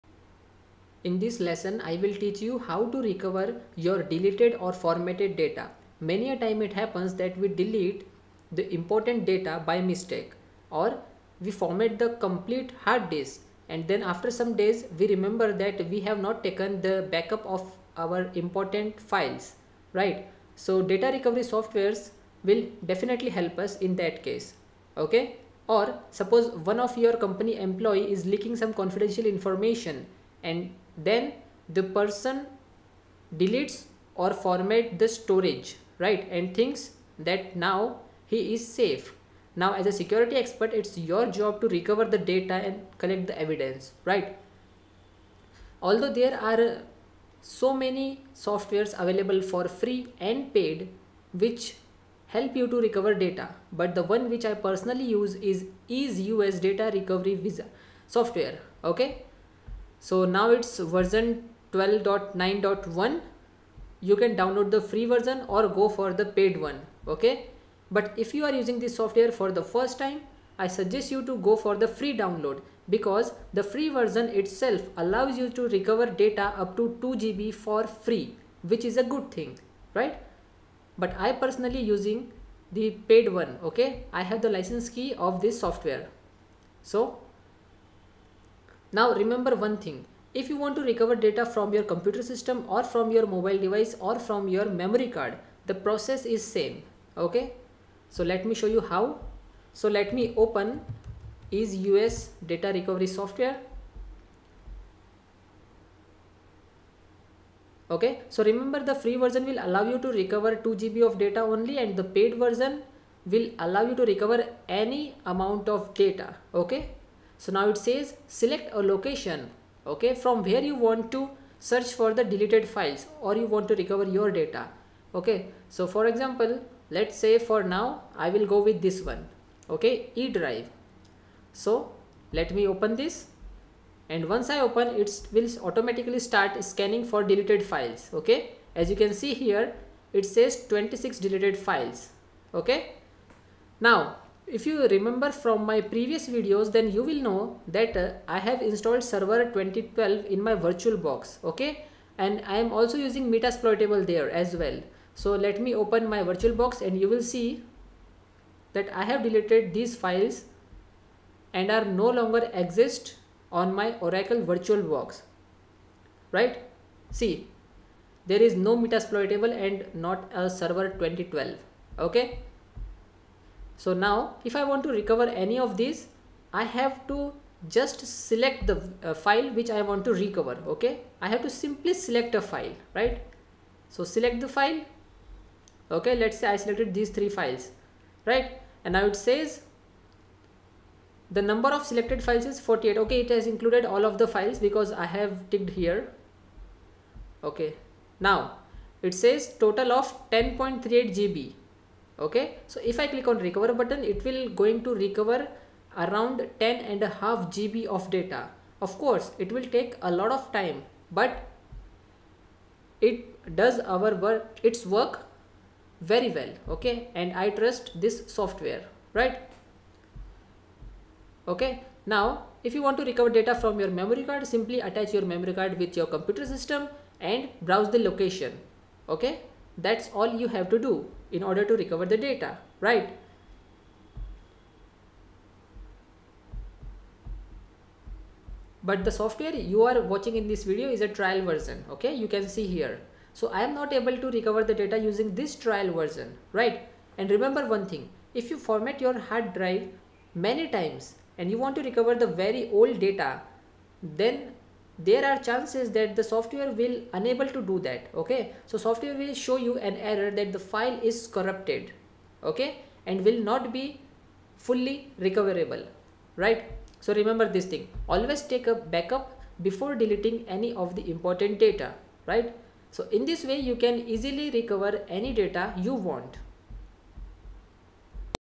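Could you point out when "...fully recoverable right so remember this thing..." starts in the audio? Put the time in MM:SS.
04:24.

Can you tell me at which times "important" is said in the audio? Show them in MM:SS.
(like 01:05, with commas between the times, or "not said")
00:08, 00:18, 04:31.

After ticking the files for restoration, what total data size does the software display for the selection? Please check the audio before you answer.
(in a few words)
10.38 GB.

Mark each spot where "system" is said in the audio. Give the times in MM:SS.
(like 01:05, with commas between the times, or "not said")
01:32, 03:46.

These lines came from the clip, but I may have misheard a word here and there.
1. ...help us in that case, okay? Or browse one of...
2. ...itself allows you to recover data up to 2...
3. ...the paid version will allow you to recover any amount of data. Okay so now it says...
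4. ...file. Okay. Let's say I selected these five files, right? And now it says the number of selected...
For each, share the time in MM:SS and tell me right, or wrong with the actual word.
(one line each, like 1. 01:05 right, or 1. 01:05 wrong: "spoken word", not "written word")
1. 00:23 wrong: "suppose", not "browse"
2. 01:14 right
3. 01:51 right
4. 03:04 wrong: "three", not "five".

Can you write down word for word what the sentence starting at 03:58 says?
But the software you are watching in this video is a trial version, okay?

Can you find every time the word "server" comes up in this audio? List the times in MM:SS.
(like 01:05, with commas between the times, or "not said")
02:29, 02:50.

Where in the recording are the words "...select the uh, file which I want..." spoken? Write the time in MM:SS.
02:58.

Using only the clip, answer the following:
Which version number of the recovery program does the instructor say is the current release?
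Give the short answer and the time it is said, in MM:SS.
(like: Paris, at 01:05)
12.9.1, at 01:01.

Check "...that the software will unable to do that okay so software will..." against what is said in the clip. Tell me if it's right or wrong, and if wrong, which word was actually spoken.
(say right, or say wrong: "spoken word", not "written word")
right.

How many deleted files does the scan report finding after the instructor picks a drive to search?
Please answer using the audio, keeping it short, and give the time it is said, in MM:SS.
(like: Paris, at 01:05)
26, at 02:20.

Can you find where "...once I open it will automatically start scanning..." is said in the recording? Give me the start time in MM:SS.
02:14.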